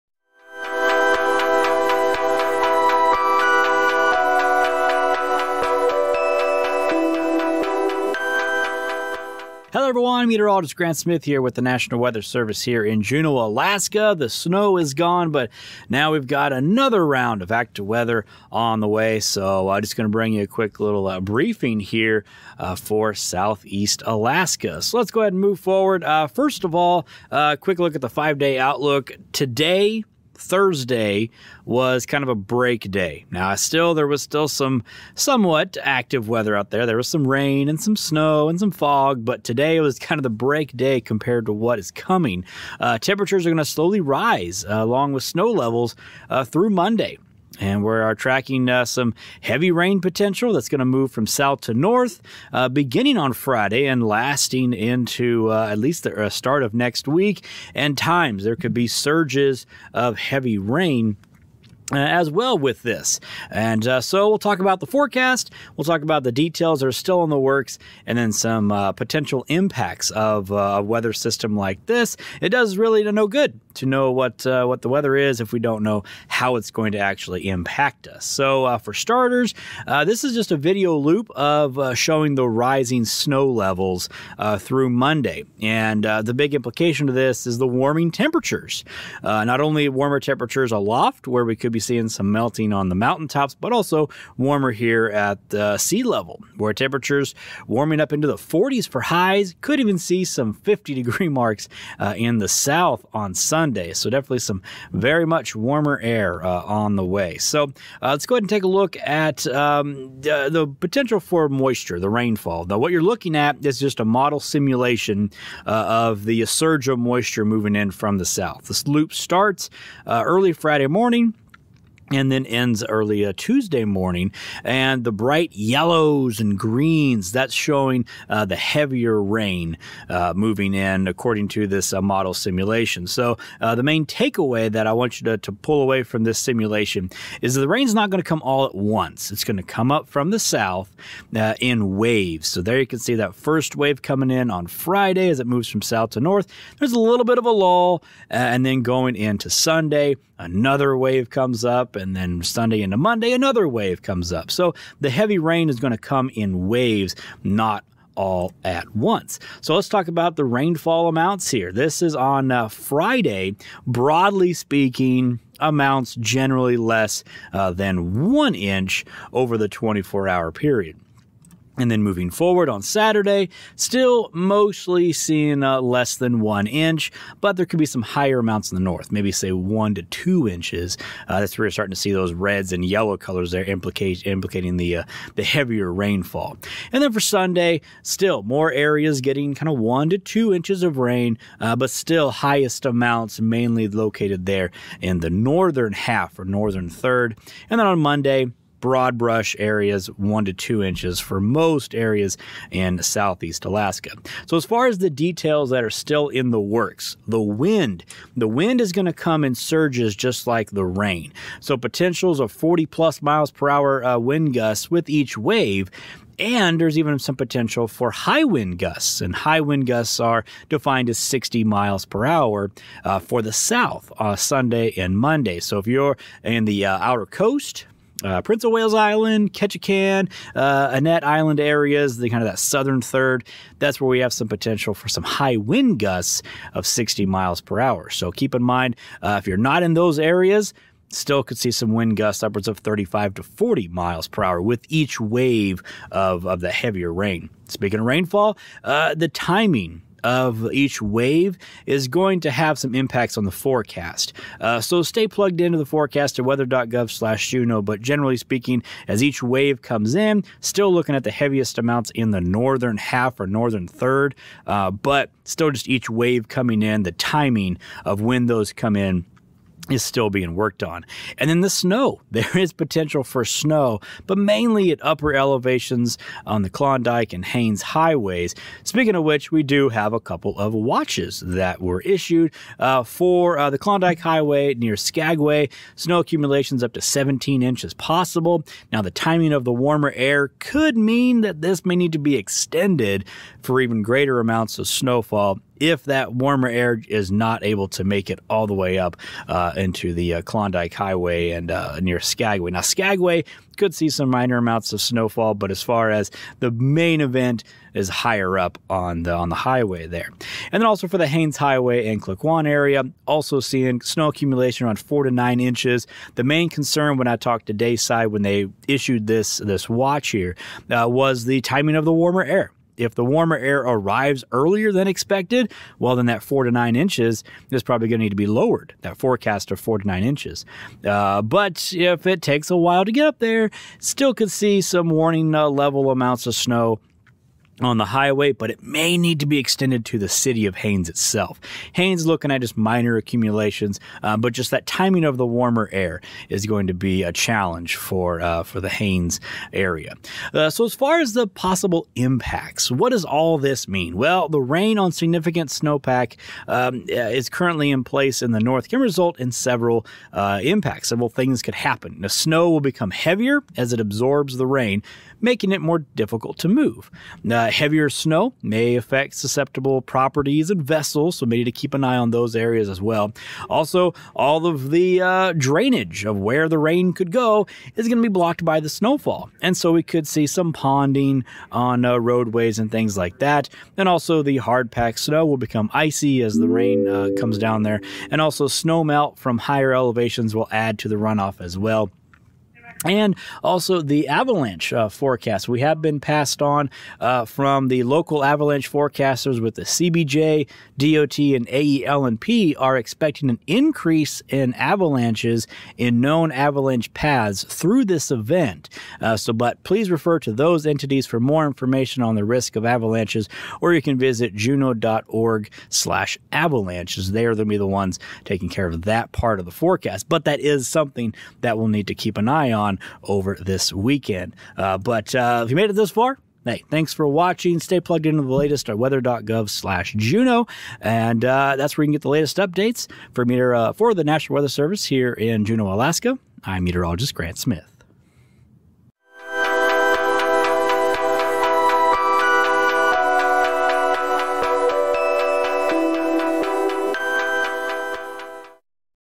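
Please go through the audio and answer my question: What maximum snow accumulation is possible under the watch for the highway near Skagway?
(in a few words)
17 inches.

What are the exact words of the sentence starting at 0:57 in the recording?
And times there could be surges of heavy rain uh, as well with this.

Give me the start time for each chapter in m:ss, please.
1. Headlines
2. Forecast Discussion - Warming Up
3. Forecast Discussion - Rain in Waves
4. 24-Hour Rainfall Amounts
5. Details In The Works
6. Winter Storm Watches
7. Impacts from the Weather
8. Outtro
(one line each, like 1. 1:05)
1. 0:26
2. 1:18
3. 1:47
4. 2:38
5. 3:23
6. 4:41
7. 5:50
8. 7:05.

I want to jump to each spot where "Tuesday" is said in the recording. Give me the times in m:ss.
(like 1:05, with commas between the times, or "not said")
2:03.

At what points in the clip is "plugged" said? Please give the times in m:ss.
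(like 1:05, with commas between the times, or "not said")
4:15, 7:08.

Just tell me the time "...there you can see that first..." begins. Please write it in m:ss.
2:22.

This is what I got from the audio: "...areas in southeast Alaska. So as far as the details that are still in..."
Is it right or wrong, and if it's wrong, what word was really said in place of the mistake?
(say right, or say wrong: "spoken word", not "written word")
right.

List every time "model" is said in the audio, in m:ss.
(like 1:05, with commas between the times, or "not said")
1:54, 2:12.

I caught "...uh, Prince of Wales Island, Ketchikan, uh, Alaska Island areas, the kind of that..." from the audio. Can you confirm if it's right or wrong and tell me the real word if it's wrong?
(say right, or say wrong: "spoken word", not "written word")
wrong: "Annette", not "Alaska".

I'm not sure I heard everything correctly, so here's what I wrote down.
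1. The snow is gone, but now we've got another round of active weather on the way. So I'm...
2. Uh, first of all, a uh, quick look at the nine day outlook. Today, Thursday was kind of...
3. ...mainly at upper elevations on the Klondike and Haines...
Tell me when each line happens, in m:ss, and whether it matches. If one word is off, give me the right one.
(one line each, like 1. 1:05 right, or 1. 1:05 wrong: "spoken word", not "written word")
1. 0:14 right
2. 0:26 wrong: "five", not "nine"
3. 4:34 right.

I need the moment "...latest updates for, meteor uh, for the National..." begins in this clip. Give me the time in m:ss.
7:12.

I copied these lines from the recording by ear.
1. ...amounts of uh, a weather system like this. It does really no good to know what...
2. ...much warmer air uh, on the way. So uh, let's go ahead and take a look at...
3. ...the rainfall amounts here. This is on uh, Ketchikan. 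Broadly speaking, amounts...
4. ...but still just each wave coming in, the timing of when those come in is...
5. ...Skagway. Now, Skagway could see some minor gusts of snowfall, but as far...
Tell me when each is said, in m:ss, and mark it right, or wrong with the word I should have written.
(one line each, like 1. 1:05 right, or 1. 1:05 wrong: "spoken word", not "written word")
1. 1:09 wrong: "impacts", not "amounts"
2. 1:45 right
3. 2:40 wrong: "Friday", not "Ketchikan"
4. 4:24 right
5. 5:02 wrong: "amounts", not "gusts".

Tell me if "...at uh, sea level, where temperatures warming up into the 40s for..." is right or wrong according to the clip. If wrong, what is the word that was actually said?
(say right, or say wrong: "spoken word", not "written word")
right.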